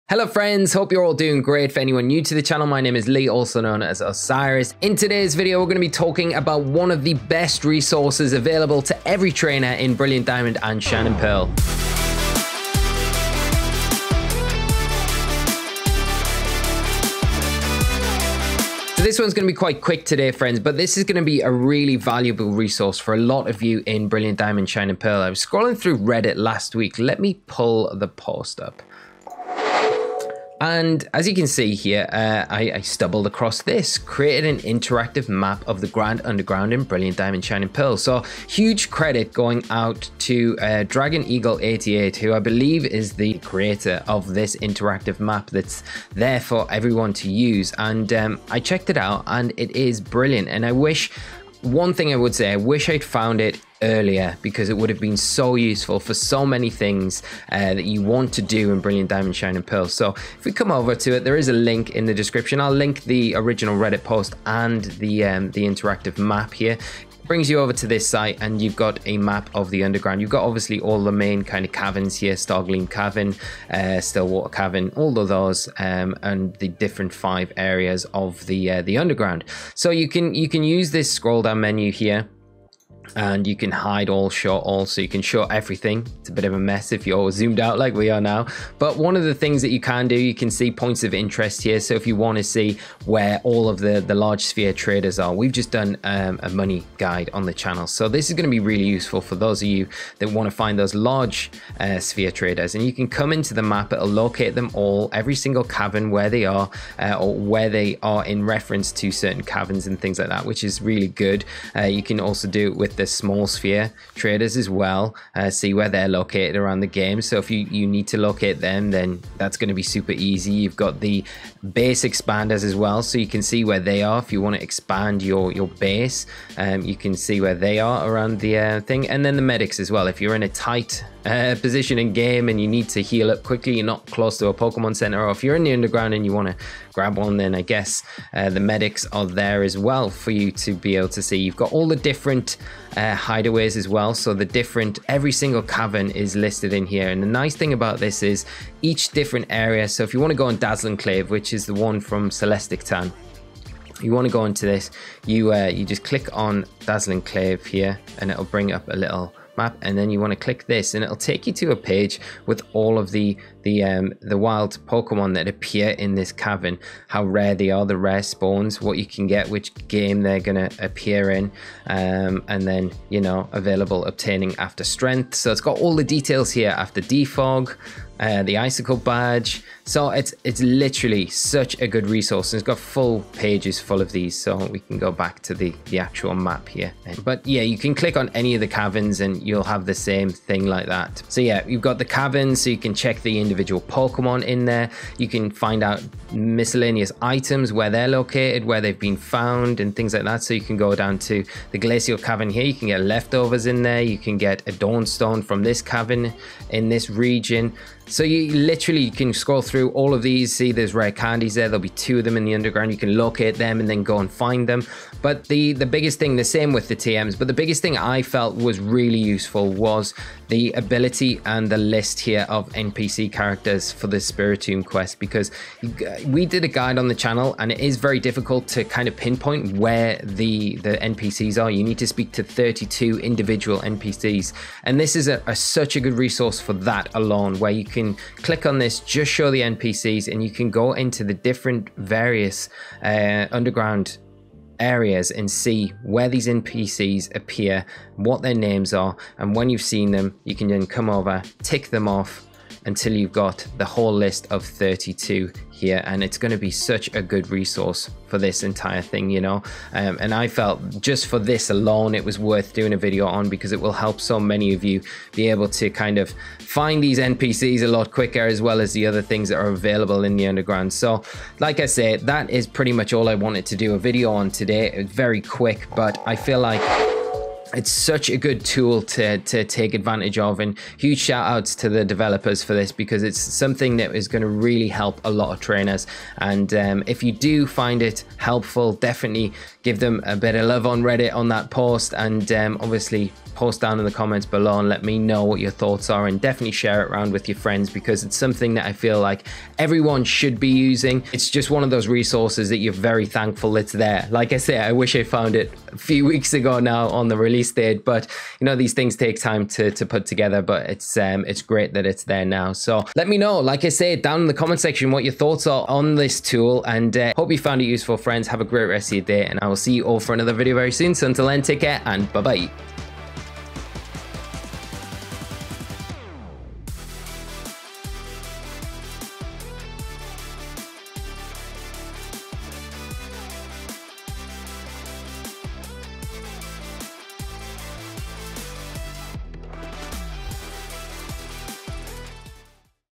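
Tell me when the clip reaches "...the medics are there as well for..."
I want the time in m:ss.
2:18.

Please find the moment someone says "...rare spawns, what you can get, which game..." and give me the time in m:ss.
2:48.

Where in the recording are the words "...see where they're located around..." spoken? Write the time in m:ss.
1:55.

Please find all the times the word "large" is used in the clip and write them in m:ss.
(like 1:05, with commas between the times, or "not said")
1:34, 1:40.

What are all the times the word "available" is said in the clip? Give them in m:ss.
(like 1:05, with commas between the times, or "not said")
0:08, 2:53, 4:29.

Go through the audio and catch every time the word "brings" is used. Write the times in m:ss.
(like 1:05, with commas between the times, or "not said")
1:07, 2:38.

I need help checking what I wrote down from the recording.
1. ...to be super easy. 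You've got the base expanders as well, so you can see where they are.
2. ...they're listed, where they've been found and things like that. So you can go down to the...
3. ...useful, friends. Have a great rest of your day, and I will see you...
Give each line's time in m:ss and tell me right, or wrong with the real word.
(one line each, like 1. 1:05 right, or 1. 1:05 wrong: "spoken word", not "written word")
1. 1:59 right
2. 3:17 wrong: "located", not "listed"
3. 5:17 right.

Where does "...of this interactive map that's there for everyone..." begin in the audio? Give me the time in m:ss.
0:44.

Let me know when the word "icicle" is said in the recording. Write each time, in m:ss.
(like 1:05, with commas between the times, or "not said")
2:58.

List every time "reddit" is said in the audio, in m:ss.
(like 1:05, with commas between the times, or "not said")
0:25, 1:03, 4:51.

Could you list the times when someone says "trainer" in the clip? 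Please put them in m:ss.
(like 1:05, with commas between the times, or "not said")
0:09, 4:45.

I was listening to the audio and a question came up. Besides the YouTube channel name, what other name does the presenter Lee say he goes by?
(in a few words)
Osirus.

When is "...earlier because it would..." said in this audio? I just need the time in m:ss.
0:53.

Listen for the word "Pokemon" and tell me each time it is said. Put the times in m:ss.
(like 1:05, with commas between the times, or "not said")
2:14, 2:44, 3:13.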